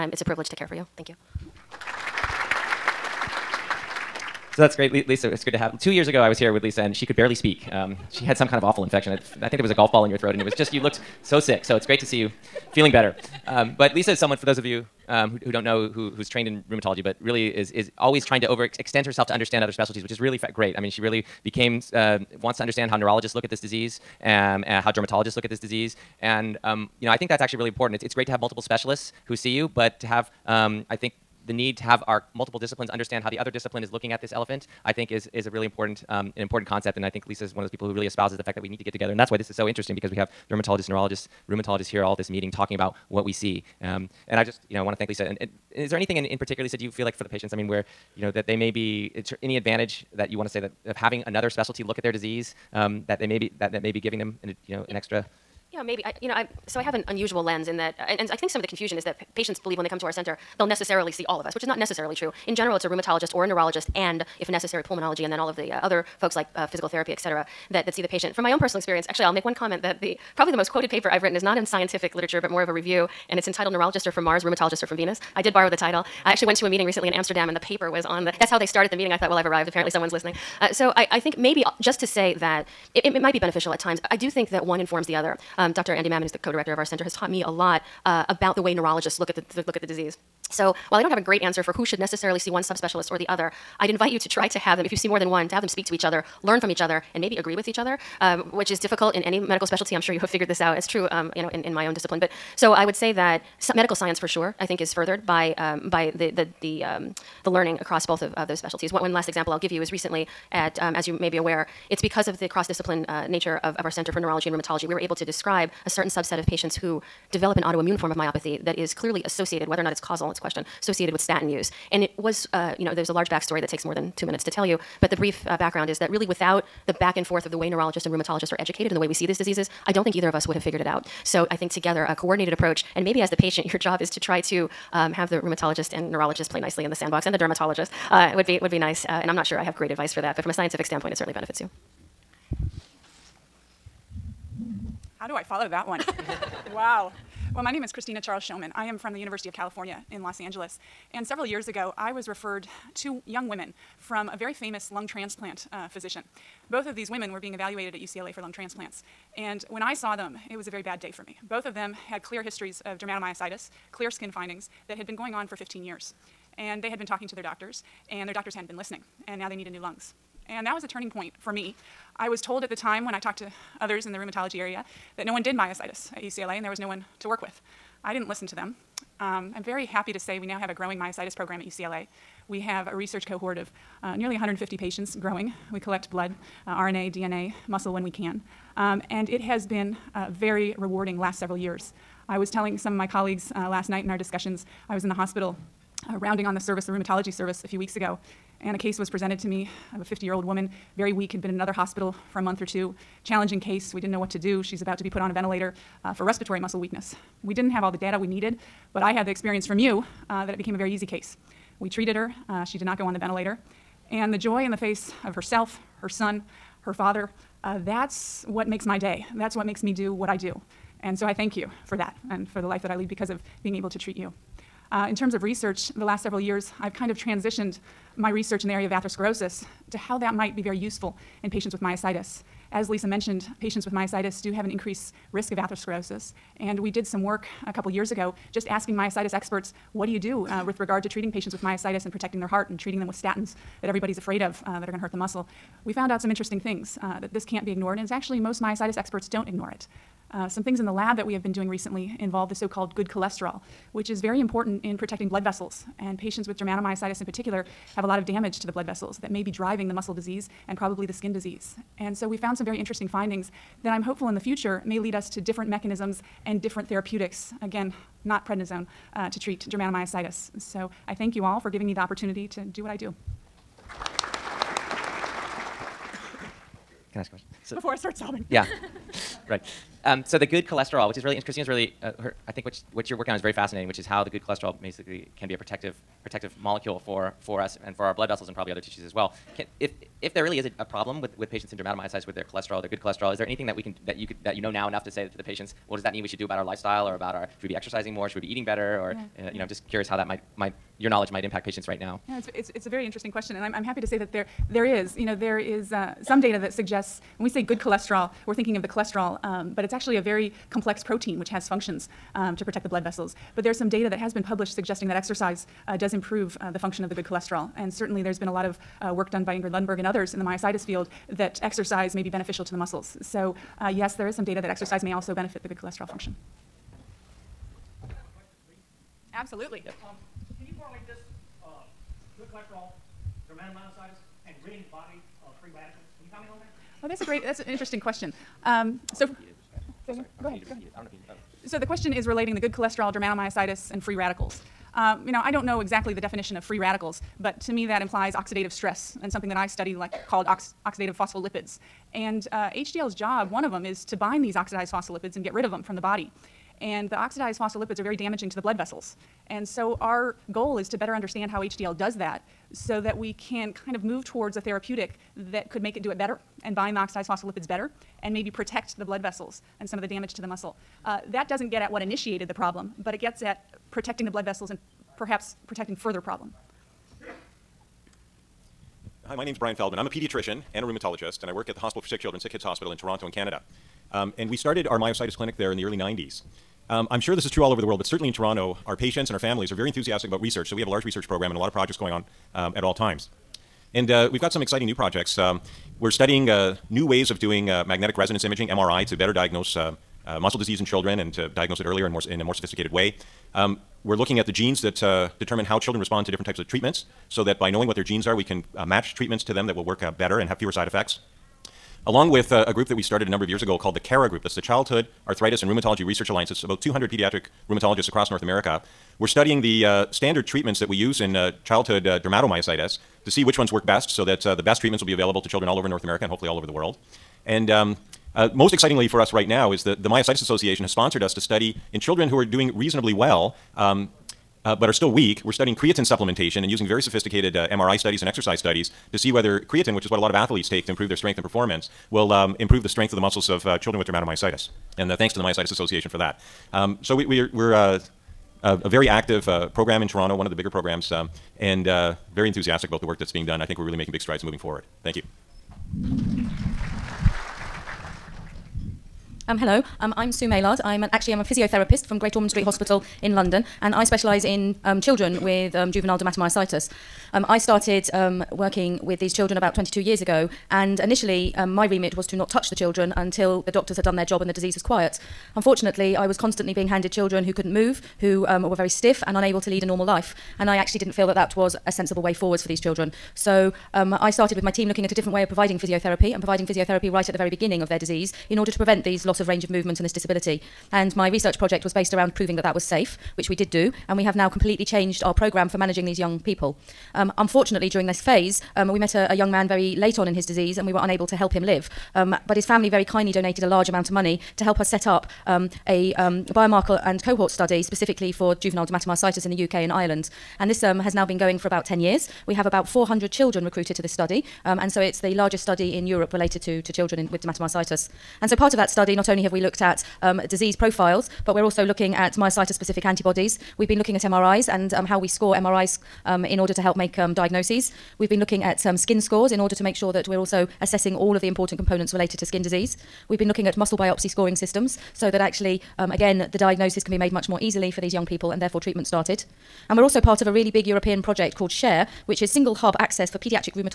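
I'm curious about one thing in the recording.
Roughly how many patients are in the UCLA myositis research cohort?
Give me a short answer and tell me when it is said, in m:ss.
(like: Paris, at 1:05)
150, at 3:04.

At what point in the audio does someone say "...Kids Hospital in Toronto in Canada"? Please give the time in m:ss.
6:22.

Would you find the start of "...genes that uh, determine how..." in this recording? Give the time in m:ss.
6:44.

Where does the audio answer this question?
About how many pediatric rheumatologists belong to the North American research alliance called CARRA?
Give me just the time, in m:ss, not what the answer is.
6:56.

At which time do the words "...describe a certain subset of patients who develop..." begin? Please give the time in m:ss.
1:55.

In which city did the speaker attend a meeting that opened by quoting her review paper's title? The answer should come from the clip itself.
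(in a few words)
Amsterdam.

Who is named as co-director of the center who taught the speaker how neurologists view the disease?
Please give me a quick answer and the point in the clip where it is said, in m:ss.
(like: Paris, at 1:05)
Andy Mammen, at 1:25.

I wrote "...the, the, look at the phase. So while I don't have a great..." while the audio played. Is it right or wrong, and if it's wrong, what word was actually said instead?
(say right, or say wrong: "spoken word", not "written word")
wrong: "disease", not "phase".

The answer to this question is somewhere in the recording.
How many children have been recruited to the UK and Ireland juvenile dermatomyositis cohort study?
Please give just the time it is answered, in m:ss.
8:32.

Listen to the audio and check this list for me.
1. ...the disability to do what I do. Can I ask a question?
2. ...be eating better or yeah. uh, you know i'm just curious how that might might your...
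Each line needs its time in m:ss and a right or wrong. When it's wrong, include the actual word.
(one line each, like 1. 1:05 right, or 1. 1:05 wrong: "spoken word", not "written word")
1. 4:31 wrong: "opportunity", not "disability"
2. 4:58 right.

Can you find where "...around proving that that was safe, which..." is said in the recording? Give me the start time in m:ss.
8:12.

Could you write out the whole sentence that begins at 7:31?
Um, and uh, very enthusiastic about the work that's being done.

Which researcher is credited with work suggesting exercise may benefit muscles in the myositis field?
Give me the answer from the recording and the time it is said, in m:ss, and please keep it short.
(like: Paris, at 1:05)
Ingrid Lundberg, at 5:19.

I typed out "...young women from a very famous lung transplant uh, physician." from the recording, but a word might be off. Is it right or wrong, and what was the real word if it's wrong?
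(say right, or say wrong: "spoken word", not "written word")
right.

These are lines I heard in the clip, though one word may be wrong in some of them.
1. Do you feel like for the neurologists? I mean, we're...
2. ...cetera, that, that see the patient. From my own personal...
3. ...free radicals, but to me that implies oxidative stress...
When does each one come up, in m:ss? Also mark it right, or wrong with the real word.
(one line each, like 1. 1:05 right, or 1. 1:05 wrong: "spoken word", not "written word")
1. 0:46 wrong: "patients", not "neurologists"
2. 1:07 right
3. 5:46 right.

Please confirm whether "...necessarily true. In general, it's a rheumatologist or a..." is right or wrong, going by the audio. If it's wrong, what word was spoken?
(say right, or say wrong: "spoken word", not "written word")
right.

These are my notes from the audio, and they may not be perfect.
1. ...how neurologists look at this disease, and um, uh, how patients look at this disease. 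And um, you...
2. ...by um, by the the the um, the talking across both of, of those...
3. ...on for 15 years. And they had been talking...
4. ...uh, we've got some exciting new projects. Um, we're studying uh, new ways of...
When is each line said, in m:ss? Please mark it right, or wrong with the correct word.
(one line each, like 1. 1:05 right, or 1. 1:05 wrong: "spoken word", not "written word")
1. 0:22 wrong: "dermatologists", not "patients"
2. 1:45 wrong: "learning", not "talking"
3. 2:45 right
4. 6:34 right.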